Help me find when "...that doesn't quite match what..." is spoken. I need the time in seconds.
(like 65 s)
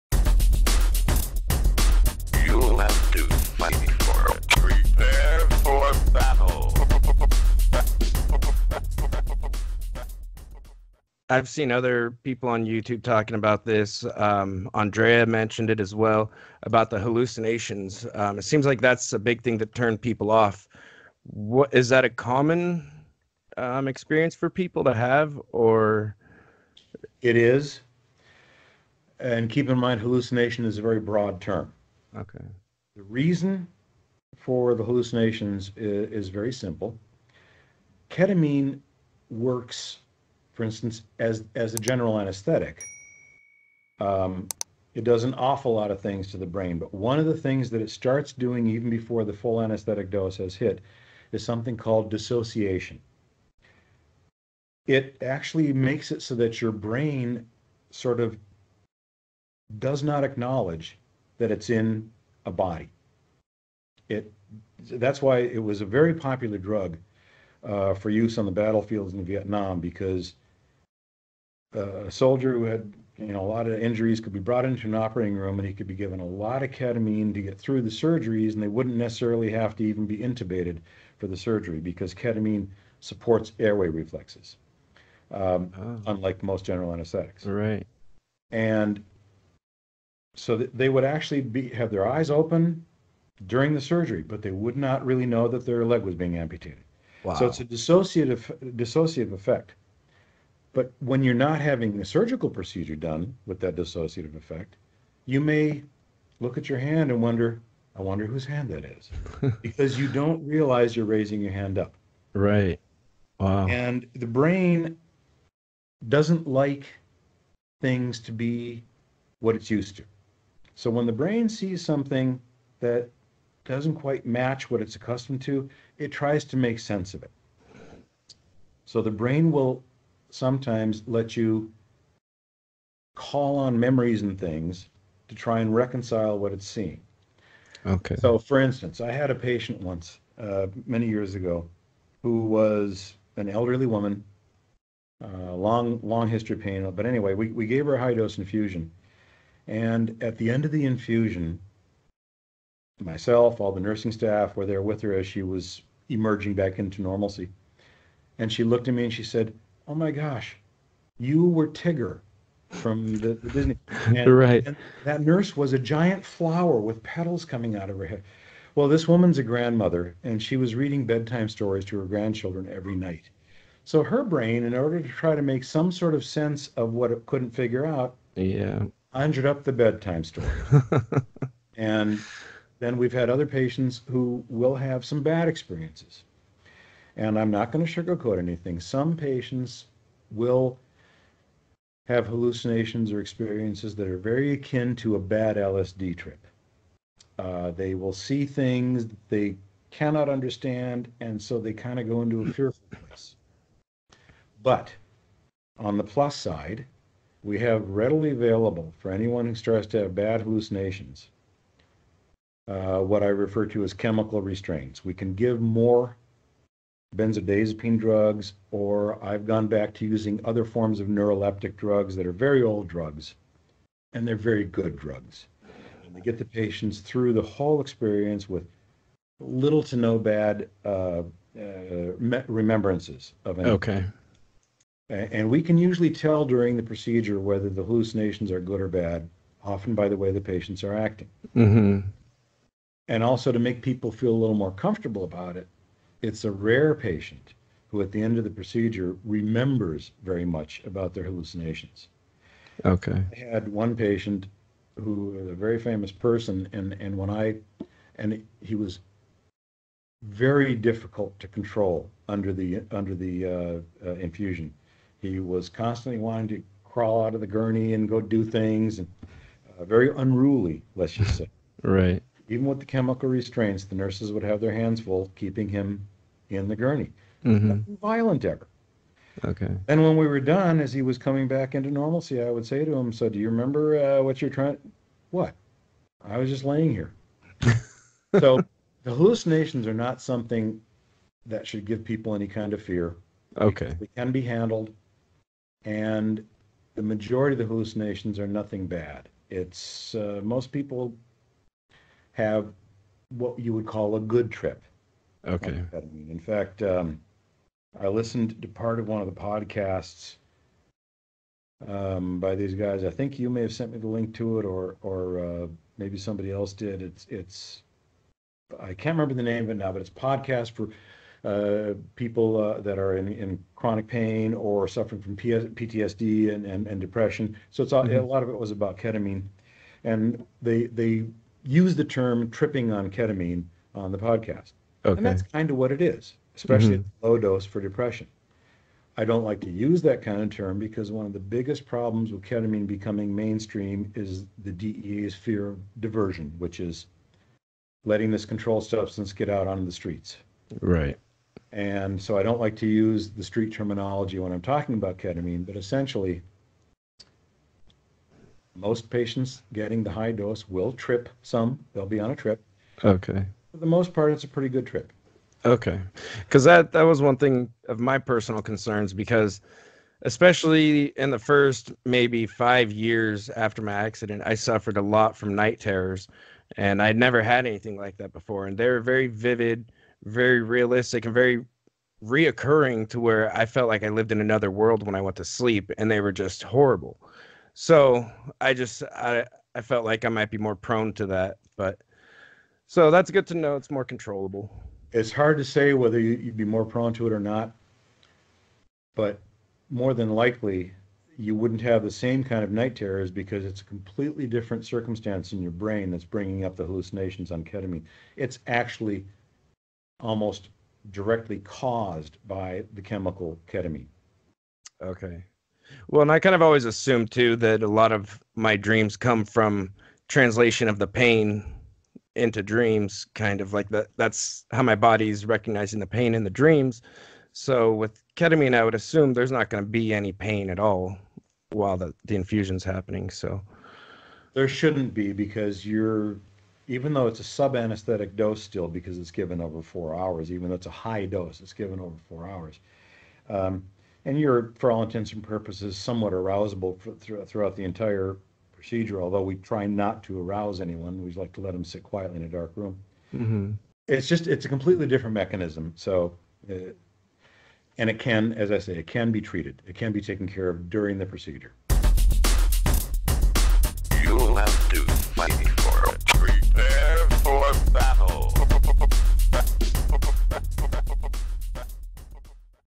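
122 s.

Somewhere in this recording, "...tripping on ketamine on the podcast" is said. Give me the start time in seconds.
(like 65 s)
332 s.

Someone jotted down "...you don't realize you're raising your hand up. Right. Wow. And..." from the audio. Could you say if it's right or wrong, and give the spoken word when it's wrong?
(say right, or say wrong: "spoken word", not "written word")
right.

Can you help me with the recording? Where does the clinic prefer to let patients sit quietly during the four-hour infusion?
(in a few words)
A dark room.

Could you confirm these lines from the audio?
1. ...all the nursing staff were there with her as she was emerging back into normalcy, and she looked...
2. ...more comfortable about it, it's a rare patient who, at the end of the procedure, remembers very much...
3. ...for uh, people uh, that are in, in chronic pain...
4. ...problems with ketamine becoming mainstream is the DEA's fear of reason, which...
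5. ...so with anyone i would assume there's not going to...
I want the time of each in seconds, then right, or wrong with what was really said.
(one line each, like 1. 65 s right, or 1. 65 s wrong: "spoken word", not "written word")
1. 153 s right
2. 244 s right
3. 320 s right
4. 341 s wrong: "diversion", not "reason"
5. 427 s wrong: "ketamine", not "anyone".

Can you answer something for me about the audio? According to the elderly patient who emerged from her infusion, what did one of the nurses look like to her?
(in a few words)
A giant flower.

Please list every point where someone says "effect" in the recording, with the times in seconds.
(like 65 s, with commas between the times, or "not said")
99 s, 104 s.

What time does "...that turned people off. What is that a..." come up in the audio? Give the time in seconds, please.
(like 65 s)
19 s.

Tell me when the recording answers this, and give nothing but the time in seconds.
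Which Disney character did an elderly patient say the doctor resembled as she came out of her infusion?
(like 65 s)
161 s.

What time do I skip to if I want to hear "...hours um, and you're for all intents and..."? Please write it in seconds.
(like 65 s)
442 s.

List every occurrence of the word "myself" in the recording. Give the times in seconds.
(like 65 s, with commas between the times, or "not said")
152 s.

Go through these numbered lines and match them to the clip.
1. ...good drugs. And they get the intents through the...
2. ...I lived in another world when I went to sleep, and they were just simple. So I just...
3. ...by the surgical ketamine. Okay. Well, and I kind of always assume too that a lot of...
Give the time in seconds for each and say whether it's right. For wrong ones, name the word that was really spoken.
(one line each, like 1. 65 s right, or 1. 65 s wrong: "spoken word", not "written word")
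1. 224 s wrong: "patients", not "intents"
2. 384 s wrong: "horrible", not "simple"
3. 412 s wrong: "chemical", not "surgical".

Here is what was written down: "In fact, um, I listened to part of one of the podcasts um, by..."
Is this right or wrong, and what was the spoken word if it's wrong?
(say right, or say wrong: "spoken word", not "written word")
right.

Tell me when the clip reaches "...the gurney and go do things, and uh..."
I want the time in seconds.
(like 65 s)
267 s.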